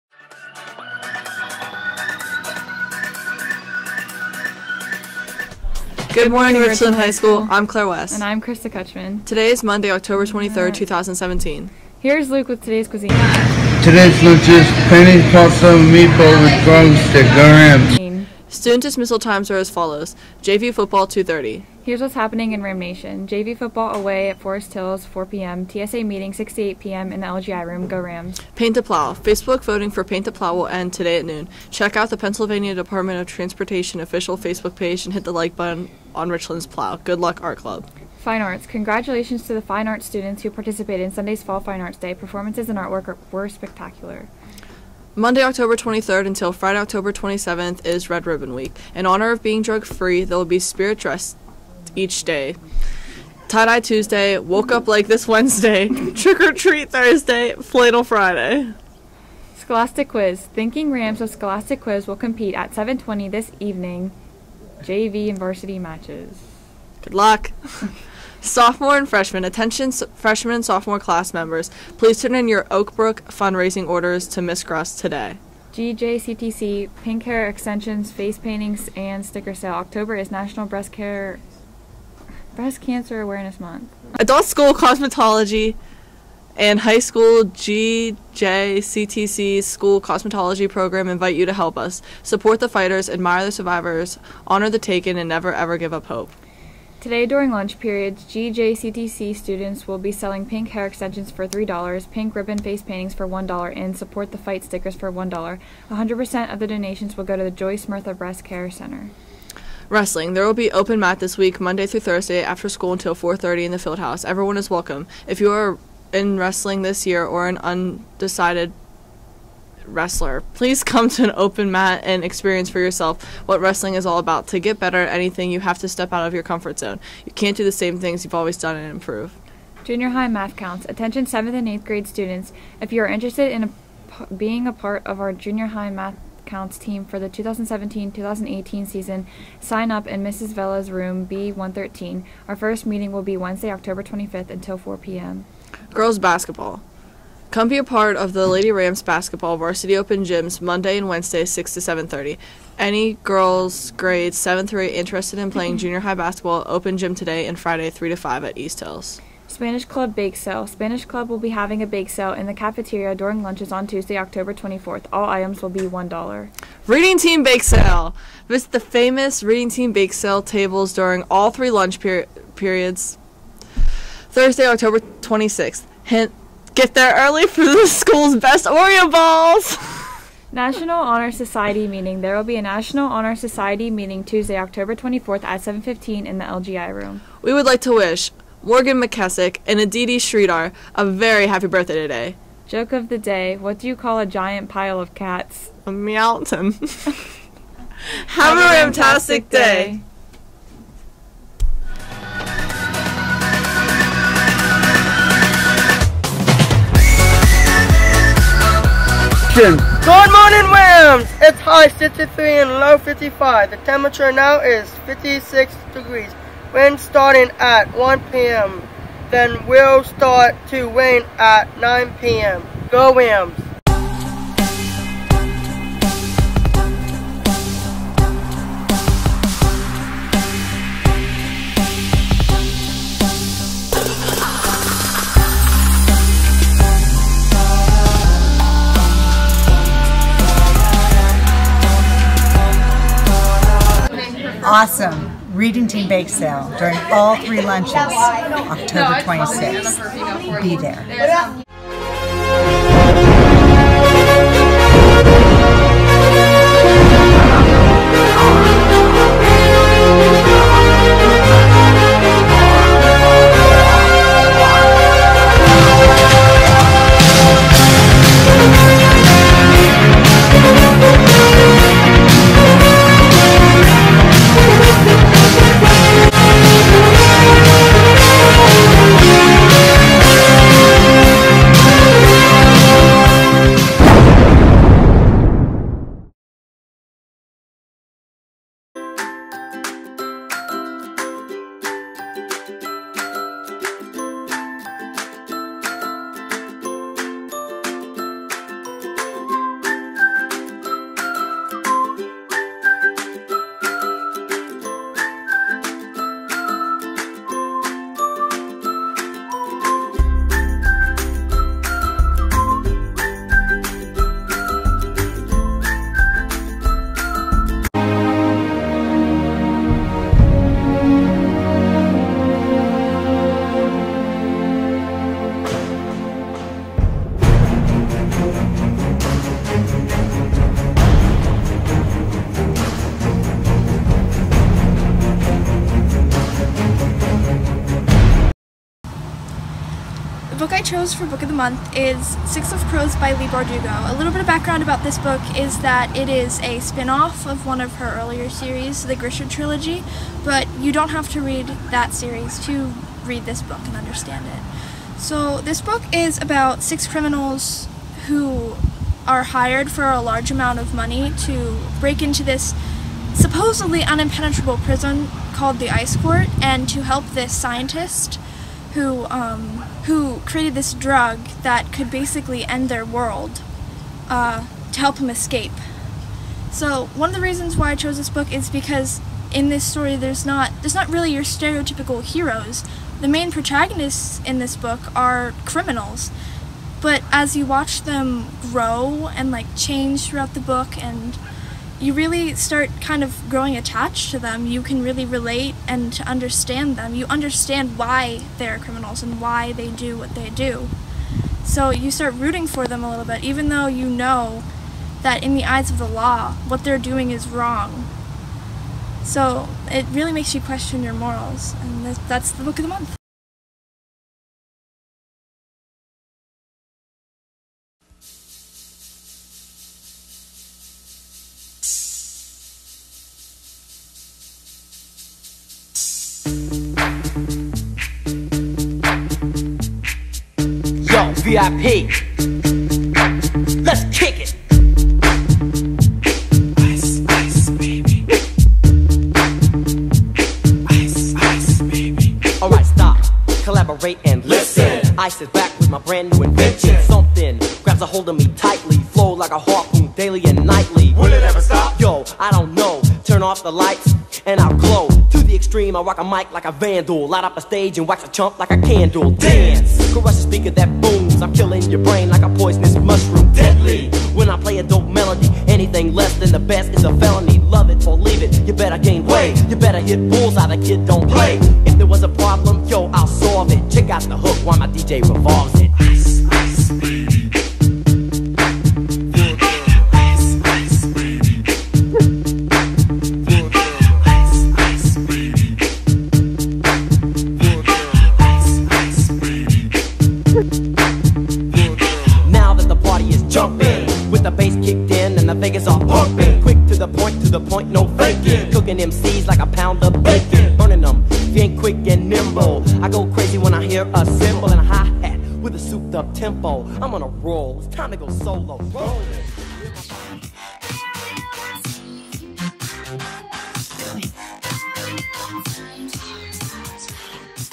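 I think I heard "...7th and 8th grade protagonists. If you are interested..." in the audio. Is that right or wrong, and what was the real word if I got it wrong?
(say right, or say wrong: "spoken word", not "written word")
wrong: "students", not "protagonists".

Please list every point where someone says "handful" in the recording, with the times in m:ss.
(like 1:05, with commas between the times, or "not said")
not said.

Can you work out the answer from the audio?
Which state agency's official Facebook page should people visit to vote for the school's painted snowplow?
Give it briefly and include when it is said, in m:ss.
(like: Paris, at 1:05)
Pennsylvania Department of Transportation, at 0:32.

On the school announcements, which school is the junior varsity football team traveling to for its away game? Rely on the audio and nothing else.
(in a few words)
Forest Hills.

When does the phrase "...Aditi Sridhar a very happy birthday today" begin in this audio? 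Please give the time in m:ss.
3:09.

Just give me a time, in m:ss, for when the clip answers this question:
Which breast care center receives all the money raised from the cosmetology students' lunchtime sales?
1:47.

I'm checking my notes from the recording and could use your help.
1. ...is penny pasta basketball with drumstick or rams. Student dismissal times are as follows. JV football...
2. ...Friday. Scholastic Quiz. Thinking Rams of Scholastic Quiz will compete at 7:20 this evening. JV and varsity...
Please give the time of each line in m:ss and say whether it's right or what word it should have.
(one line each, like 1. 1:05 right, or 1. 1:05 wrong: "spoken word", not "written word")
1. 0:14 wrong: "meatball", not "basketball"
2. 0:58 right.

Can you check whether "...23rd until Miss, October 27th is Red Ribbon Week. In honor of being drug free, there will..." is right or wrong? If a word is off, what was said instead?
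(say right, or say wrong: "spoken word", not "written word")
wrong: "Friday", not "Miss".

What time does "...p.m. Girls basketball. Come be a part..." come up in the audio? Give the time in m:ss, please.
2:24.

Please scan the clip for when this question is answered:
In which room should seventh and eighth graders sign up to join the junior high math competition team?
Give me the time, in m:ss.
2:21.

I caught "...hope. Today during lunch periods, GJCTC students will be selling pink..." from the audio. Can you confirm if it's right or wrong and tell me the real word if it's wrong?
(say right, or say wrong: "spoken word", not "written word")
right.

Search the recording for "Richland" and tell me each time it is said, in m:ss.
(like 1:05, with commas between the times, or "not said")
0:06, 0:36.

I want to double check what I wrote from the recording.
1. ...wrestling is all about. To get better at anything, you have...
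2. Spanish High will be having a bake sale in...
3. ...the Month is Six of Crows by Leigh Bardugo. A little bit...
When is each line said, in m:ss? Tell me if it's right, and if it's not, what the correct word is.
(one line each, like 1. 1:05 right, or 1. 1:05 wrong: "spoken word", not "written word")
1. 2:03 right
2. 2:40 wrong: "Club", not "High"
3. 5:41 right.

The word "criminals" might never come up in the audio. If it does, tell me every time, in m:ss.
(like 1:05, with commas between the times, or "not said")
5:57, 6:25, 6:38.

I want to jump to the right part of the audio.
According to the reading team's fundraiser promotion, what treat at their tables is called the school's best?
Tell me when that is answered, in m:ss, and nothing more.
2:58.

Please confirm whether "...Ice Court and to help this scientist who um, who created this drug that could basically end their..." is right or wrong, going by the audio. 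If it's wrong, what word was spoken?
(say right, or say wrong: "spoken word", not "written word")
right.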